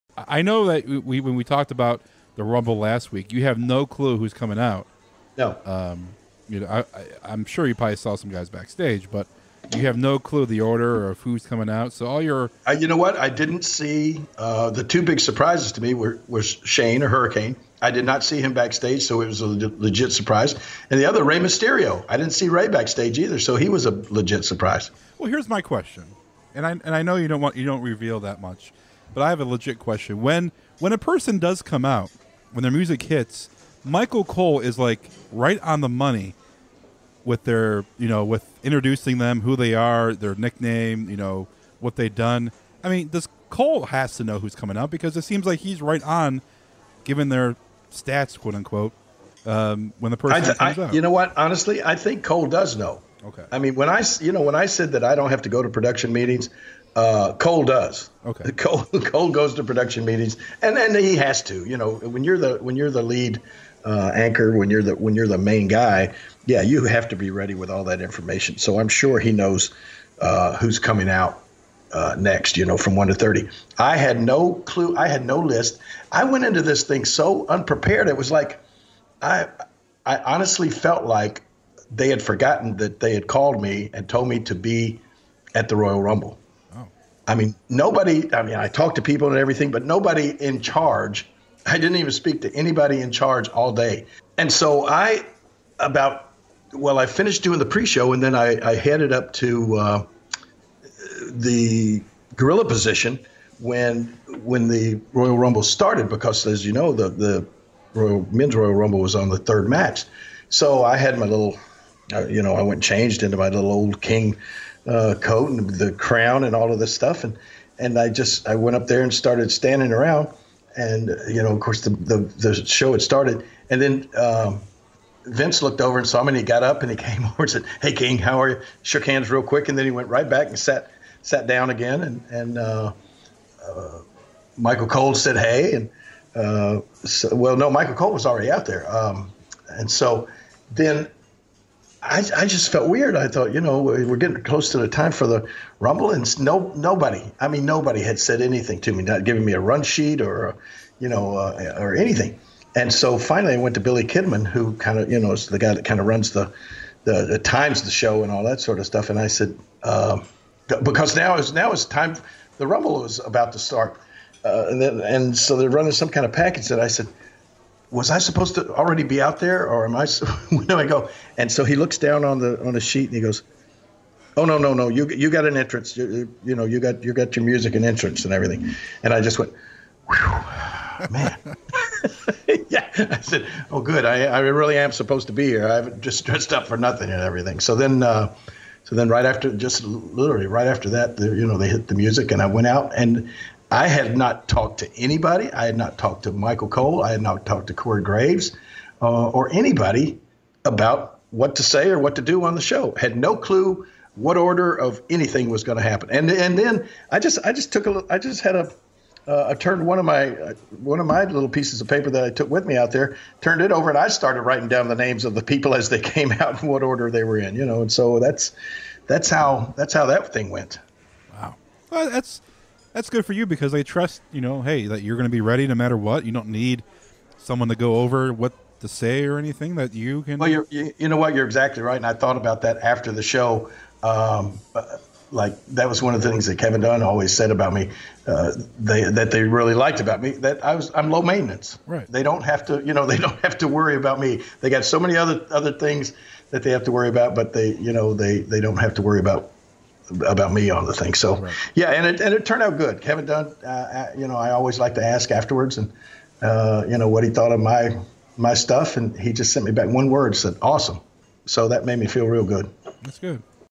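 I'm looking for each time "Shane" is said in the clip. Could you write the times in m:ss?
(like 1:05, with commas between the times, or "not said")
0:16.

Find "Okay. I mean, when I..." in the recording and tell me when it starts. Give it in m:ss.
0:53.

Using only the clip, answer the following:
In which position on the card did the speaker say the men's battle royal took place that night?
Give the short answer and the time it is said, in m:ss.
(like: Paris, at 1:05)
Third match, at 1:49.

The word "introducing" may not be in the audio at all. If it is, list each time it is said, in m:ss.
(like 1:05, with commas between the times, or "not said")
0:38.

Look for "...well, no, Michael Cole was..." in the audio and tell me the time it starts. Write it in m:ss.
2:17.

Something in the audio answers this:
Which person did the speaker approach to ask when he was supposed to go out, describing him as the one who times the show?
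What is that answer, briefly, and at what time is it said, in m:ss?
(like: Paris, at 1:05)
Billy Kidman, at 2:33.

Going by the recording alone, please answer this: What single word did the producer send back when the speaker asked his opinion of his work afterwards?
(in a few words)
Awesome.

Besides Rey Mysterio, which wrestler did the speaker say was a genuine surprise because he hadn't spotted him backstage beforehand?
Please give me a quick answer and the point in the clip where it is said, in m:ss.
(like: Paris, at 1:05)
Hurricane, at 0:17.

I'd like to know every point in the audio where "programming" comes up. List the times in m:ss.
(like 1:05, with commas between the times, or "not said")
not said.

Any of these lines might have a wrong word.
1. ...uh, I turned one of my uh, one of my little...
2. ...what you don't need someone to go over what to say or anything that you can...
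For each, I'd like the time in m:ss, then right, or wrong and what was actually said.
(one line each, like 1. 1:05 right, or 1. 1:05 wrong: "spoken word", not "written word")
1. 3:29 right
2. 3:45 right.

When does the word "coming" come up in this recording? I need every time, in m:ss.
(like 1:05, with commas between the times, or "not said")
0:04, 0:11, 0:44, 1:10.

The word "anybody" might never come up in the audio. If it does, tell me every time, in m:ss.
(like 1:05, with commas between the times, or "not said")
1:32, 3:15, 3:19.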